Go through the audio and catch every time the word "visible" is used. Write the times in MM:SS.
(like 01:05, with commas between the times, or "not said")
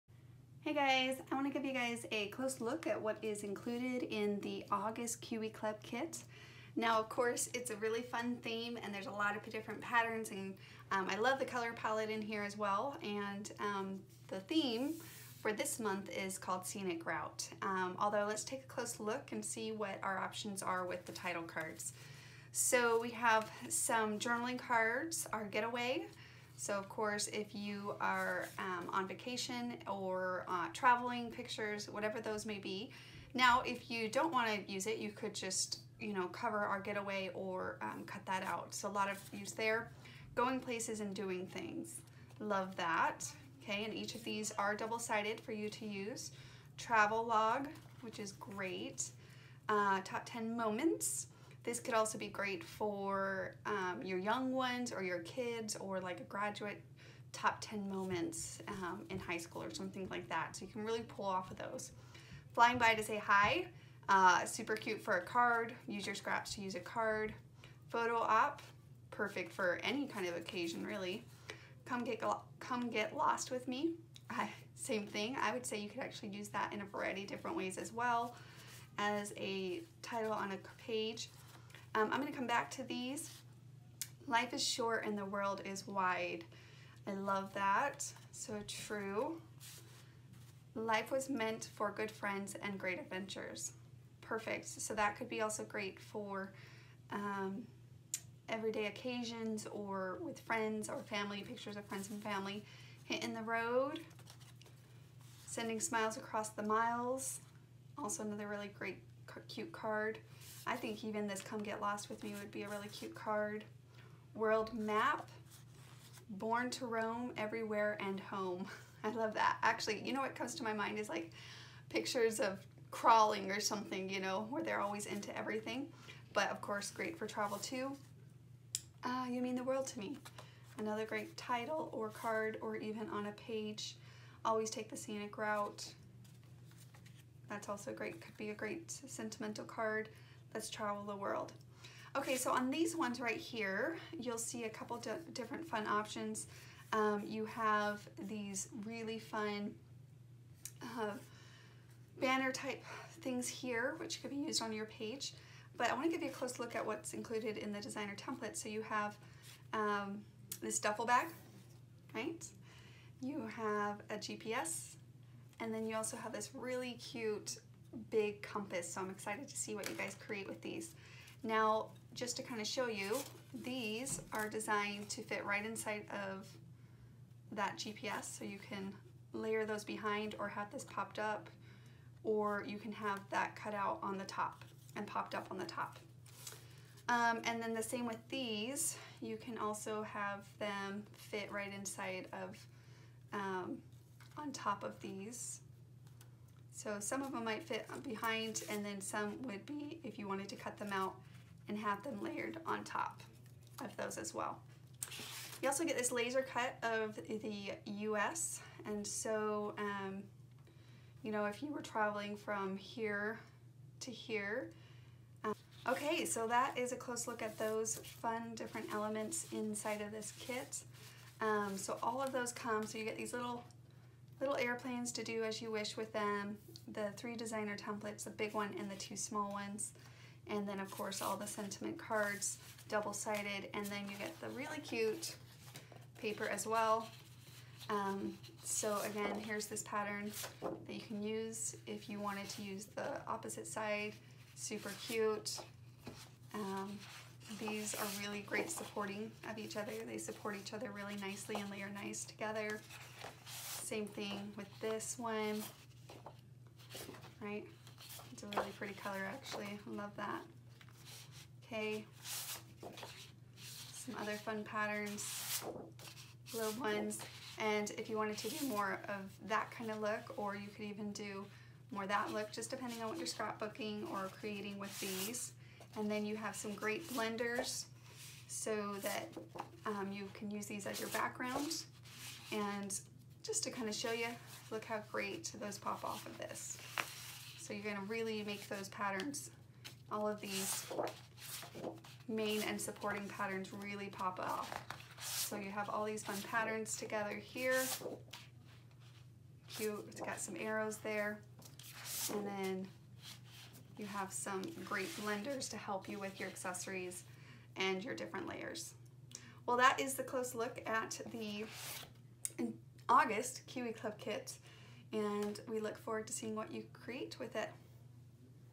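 not said.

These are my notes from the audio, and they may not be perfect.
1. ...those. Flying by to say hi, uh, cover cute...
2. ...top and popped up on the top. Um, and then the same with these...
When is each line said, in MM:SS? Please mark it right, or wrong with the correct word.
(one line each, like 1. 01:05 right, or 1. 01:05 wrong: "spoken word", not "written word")
1. 01:01 wrong: "super", not "cover"
2. 03:04 right.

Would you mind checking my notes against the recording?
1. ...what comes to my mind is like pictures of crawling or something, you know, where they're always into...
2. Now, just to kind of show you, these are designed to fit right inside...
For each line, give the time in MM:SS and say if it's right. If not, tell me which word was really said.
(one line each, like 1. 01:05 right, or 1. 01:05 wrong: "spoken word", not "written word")
1. 02:00 right
2. 02:51 right.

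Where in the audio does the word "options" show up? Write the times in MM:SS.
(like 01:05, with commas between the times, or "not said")
00:20, 02:25.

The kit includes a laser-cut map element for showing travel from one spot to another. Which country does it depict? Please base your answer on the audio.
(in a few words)
US.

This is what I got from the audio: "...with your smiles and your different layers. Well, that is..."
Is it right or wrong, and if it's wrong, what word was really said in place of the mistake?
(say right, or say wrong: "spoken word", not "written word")
wrong: "accessories", not "smiles".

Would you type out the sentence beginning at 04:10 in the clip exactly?
They support each other really nicely and layer nice together.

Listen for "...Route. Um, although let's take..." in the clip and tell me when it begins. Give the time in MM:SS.
00:17.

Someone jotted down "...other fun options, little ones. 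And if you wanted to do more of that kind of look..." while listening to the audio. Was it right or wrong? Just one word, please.
wrong.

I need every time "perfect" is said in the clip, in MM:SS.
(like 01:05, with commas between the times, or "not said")
01:09, 01:34.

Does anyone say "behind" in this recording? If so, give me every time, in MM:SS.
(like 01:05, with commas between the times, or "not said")
02:59, 03:18.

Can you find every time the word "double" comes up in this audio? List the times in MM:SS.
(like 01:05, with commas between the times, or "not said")
00:44, 03:52.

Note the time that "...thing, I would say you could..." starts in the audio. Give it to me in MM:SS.
01:15.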